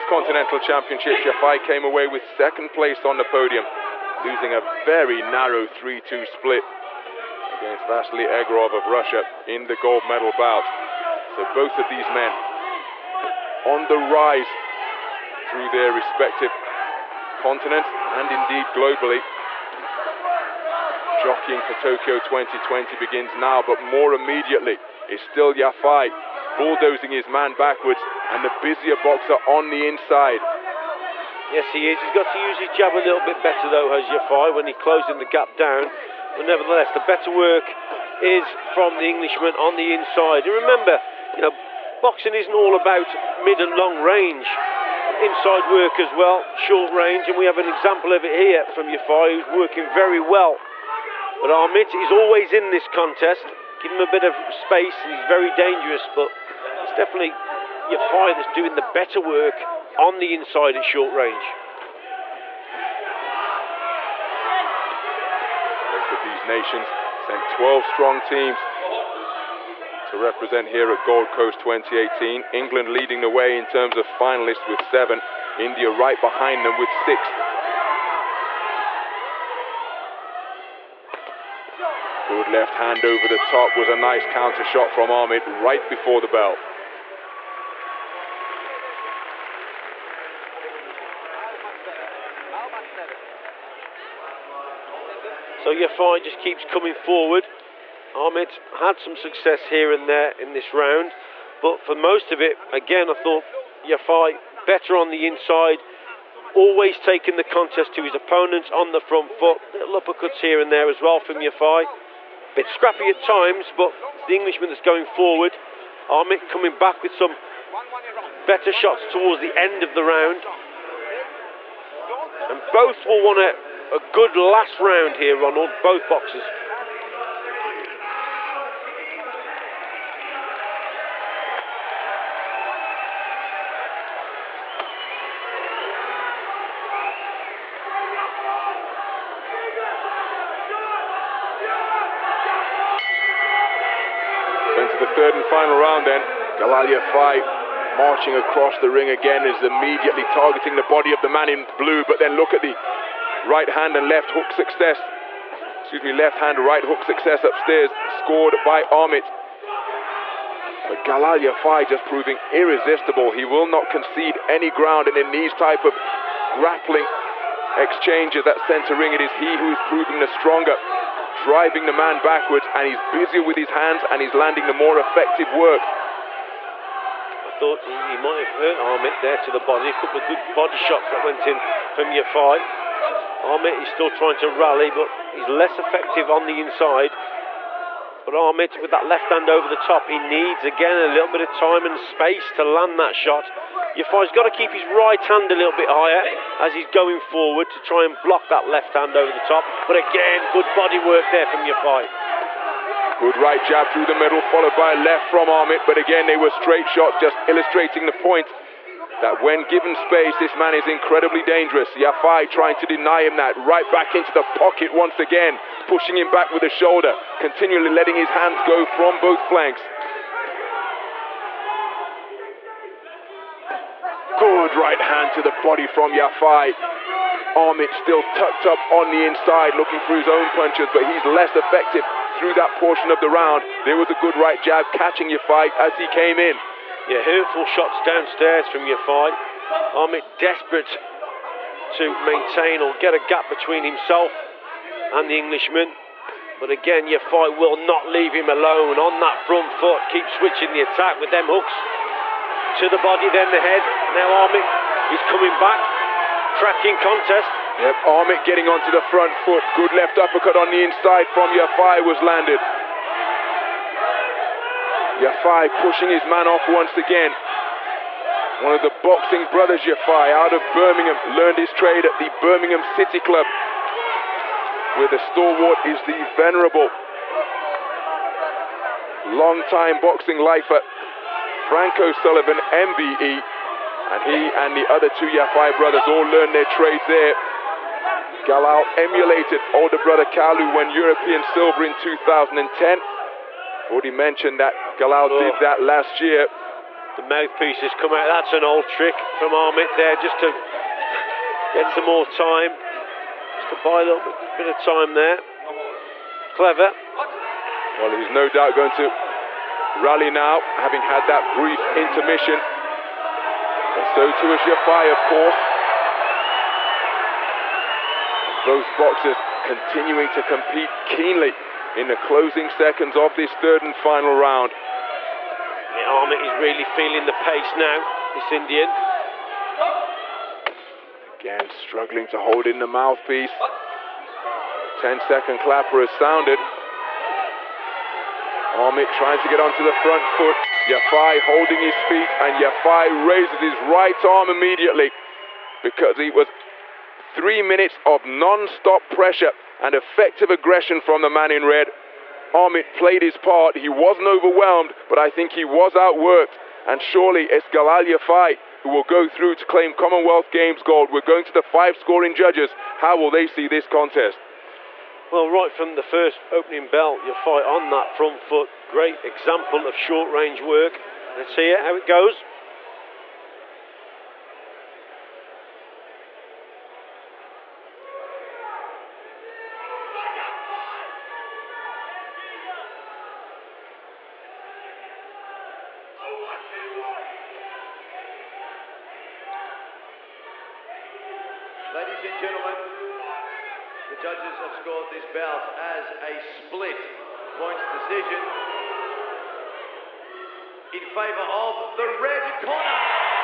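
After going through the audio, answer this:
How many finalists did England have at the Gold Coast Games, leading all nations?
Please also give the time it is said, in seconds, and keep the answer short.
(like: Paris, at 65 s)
7, at 74 s.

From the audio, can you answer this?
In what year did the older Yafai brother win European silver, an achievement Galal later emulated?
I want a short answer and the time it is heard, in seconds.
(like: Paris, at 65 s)
2010, at 291 s.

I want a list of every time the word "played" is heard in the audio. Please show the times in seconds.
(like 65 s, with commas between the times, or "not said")
352 s.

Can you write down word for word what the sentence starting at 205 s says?
But again, they were straight shots, just illustrating the point that when given space, this man is incredibly dangerous.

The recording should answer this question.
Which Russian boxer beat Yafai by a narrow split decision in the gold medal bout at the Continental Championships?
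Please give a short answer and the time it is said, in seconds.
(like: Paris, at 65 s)
Vasily Egorov, at 7 s.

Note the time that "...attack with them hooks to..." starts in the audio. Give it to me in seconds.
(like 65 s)
250 s.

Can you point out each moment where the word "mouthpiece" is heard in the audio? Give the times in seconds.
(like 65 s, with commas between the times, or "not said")
297 s, 332 s.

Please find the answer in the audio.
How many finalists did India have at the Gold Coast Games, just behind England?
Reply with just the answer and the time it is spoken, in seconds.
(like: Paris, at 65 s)
6, at 77 s.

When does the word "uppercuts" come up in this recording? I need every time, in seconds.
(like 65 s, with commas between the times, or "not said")
110 s, 260 s.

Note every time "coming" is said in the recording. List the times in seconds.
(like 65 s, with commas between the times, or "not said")
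96 s, 116 s, 255 s.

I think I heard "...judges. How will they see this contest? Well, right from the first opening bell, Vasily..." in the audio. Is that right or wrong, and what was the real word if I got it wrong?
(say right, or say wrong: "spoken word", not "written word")
wrong: "Yafai", not "Vasily".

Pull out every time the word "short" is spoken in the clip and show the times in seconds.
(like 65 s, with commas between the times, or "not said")
46 s, 60 s, 369 s.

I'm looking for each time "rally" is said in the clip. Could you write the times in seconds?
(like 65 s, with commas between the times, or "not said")
184 s, 309 s.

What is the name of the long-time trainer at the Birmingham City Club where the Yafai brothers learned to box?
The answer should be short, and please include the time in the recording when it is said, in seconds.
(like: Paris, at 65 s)
Frank O'Sullivan, at 281 s.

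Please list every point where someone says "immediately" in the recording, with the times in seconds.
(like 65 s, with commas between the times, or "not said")
24 s, 149 s, 344 s.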